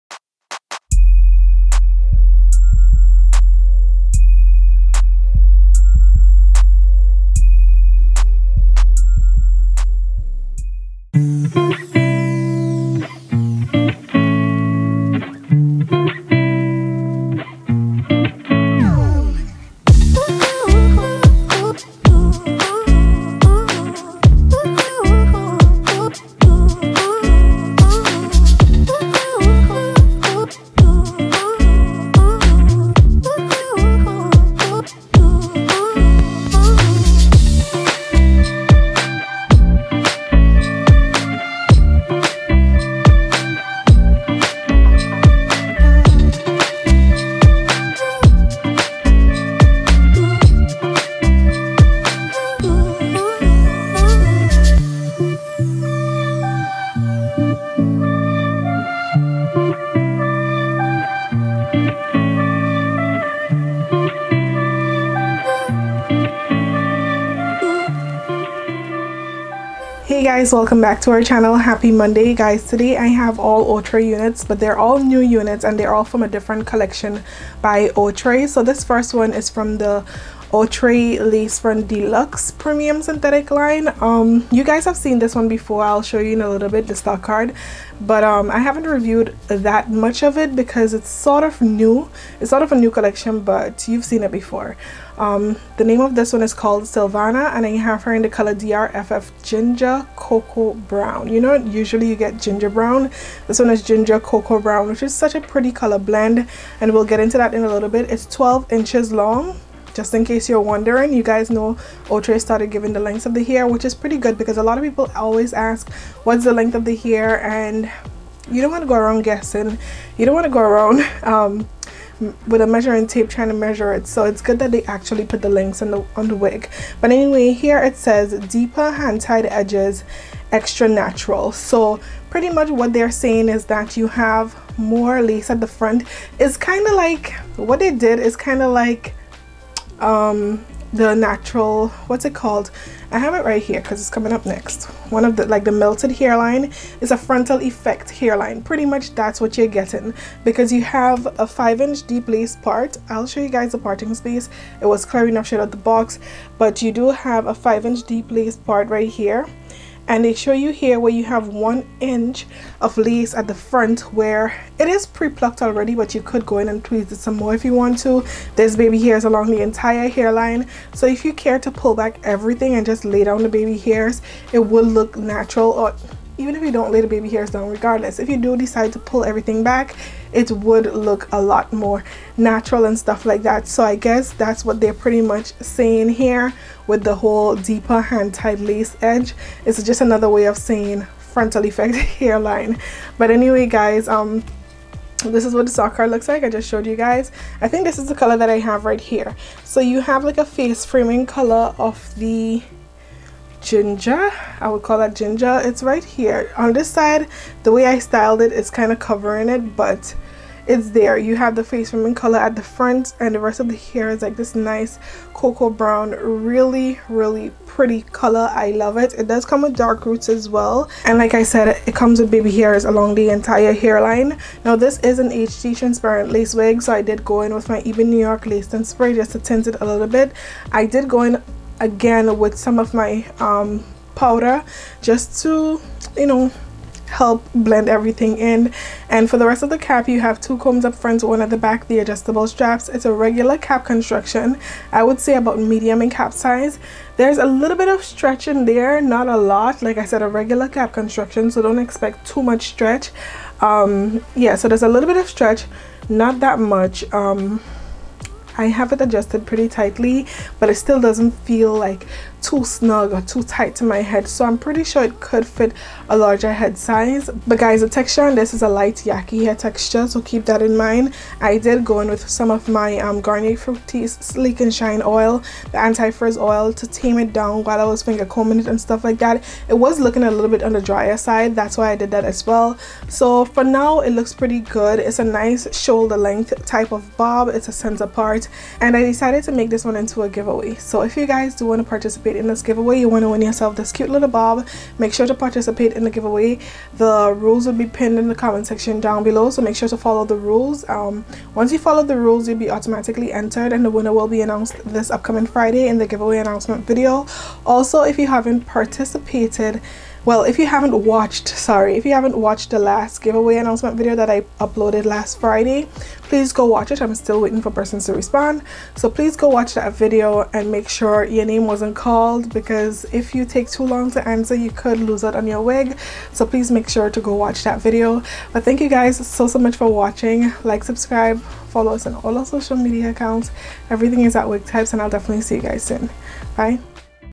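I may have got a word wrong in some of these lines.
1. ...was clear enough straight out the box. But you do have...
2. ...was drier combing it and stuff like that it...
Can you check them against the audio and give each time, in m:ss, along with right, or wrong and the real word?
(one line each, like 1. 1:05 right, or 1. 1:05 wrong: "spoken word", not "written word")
1. 2:34 right
2. 4:37 wrong: "finger", not "drier".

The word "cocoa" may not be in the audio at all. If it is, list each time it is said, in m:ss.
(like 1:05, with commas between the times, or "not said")
1:40, 1:44, 3:35.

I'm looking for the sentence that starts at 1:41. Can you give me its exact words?
You know, usually you get ginger brown.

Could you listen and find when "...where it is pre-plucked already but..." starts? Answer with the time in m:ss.
2:44.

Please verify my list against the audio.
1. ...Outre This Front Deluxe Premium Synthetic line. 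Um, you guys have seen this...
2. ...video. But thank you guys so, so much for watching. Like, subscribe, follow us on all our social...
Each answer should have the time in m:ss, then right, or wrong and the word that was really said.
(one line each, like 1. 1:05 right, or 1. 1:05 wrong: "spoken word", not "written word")
1. 1:20 wrong: "Lace", not "This"
2. 5:27 right.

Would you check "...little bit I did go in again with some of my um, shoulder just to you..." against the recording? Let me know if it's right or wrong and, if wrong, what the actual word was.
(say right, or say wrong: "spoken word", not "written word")
wrong: "powder", not "shoulder".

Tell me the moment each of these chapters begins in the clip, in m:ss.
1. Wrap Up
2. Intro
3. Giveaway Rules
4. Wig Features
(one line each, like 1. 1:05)
1. 5:29
2. 1:10
3. 4:48
4. 1:36.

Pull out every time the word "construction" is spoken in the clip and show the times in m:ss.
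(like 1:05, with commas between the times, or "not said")
4:03, 4:10.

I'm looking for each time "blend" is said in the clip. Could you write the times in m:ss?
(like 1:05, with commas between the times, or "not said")
1:45, 3:57.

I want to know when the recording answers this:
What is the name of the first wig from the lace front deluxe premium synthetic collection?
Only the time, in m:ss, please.
1:36.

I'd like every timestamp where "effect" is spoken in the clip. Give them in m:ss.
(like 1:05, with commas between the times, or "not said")
2:27, 3:11.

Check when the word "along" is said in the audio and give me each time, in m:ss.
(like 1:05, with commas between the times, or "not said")
2:49, 3:42.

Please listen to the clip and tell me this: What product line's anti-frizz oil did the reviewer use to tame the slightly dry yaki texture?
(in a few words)
Garnier Fructis Sleek and Shine.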